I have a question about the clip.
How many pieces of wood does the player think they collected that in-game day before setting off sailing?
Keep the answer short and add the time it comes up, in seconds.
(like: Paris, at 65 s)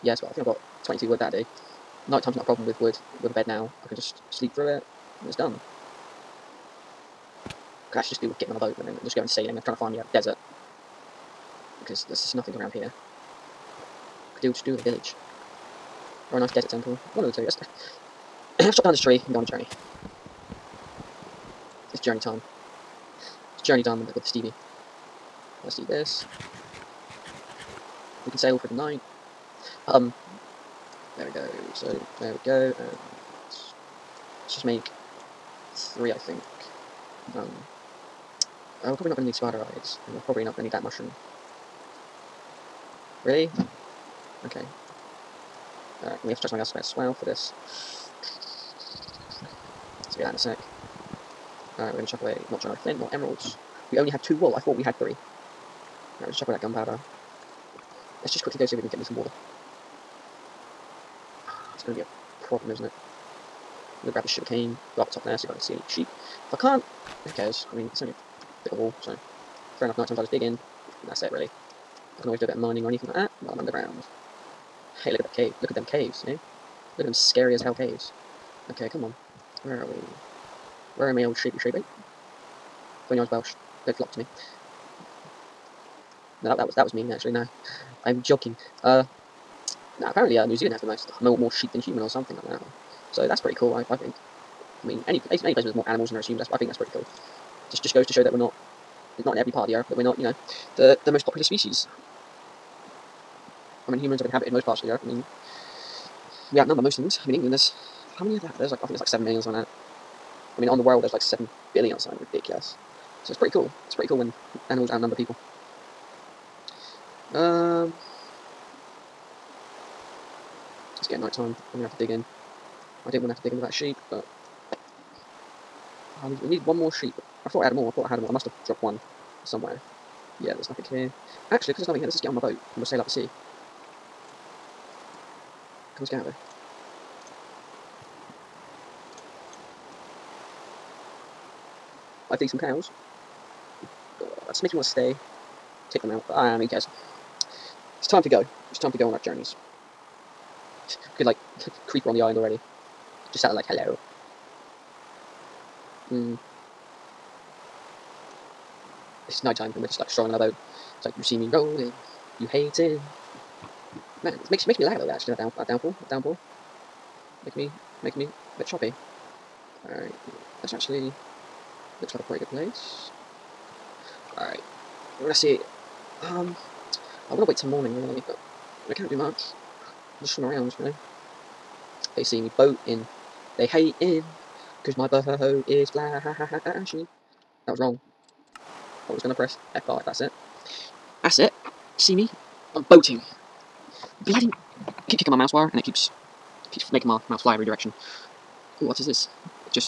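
22, at 0 s.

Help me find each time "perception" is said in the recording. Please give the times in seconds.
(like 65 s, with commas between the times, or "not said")
not said.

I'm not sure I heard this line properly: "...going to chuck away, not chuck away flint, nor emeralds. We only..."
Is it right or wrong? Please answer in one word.
right.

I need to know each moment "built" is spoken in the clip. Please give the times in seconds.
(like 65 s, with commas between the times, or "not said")
not said.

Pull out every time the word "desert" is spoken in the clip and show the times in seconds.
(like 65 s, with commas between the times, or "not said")
10 s, 16 s.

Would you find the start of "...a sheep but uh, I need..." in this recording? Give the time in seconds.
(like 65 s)
123 s.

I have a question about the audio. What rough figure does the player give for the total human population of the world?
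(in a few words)
7 billion.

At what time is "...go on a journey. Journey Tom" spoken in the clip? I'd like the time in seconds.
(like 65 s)
19 s.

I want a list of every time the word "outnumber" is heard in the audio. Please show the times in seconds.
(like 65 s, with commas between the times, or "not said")
106 s, 114 s.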